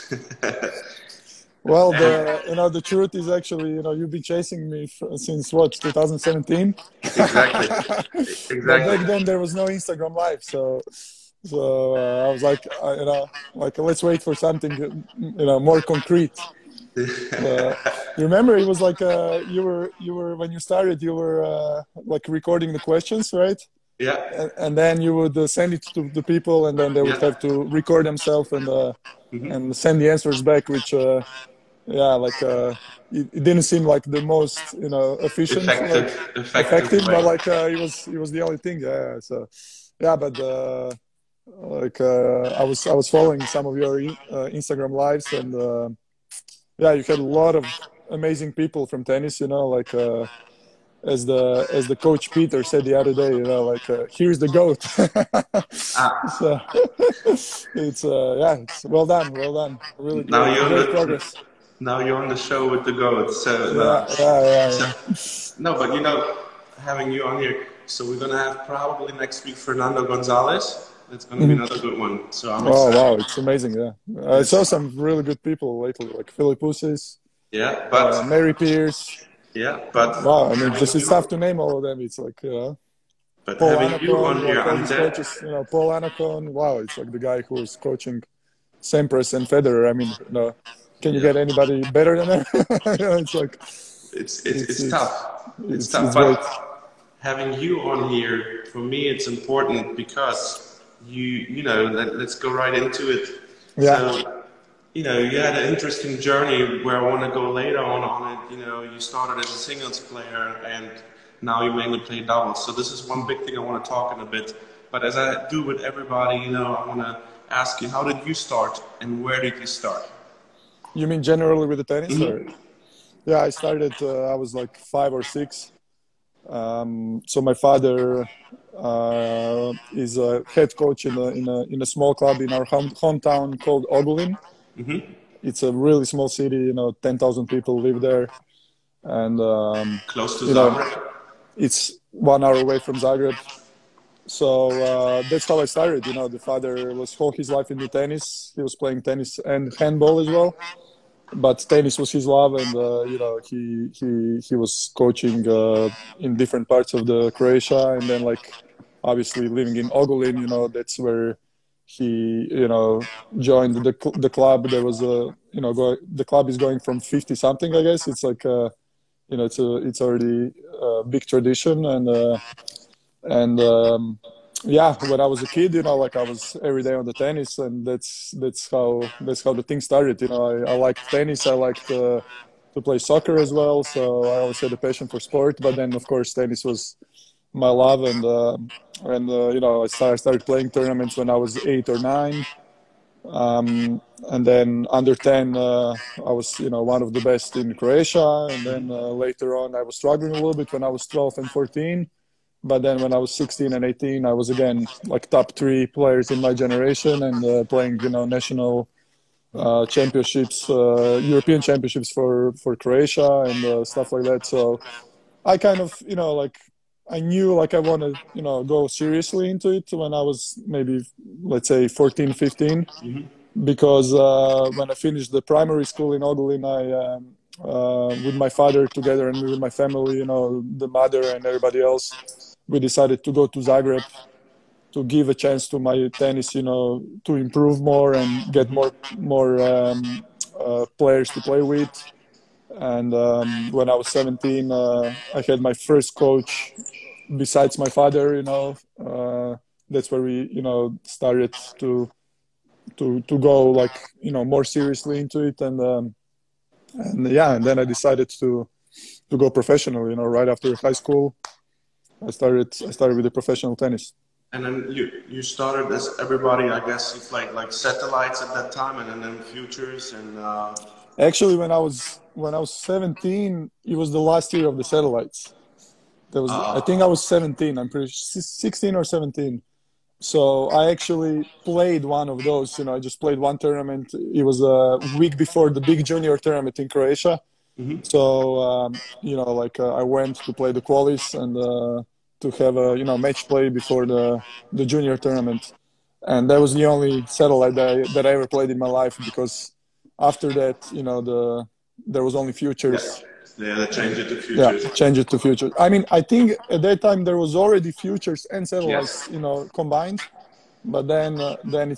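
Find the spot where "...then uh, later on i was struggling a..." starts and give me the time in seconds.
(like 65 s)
198 s.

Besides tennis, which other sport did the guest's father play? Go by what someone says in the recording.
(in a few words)
Handball.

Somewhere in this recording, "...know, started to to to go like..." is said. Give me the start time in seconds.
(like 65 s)
250 s.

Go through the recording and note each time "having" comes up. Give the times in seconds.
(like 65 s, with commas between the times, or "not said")
66 s, 83 s, 97 s.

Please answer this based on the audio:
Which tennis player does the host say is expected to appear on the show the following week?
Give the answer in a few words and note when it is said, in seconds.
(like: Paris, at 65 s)
Fernando Gonzalez, at 69 s.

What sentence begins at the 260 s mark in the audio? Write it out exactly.
You know, right after high school.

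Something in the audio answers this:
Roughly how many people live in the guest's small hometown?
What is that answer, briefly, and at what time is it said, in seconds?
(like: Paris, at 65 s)
10,000, at 137 s.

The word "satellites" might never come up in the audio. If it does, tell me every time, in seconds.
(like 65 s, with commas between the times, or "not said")
267 s, 274 s, 297 s, 308 s.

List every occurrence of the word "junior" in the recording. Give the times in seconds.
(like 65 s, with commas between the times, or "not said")
286 s, 294 s.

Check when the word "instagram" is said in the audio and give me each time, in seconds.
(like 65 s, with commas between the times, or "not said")
9 s, 44 s.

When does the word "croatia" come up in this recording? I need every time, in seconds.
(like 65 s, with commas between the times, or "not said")
157 s, 197 s, 212 s, 286 s.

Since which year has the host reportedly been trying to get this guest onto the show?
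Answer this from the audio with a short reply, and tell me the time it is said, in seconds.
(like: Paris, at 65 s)
2017, at 5 s.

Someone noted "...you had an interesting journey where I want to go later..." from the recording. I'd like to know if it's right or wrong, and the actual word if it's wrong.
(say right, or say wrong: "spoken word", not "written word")
right.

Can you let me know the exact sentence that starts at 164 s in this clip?
There was a you know go- the club is going from fifty something, I guess.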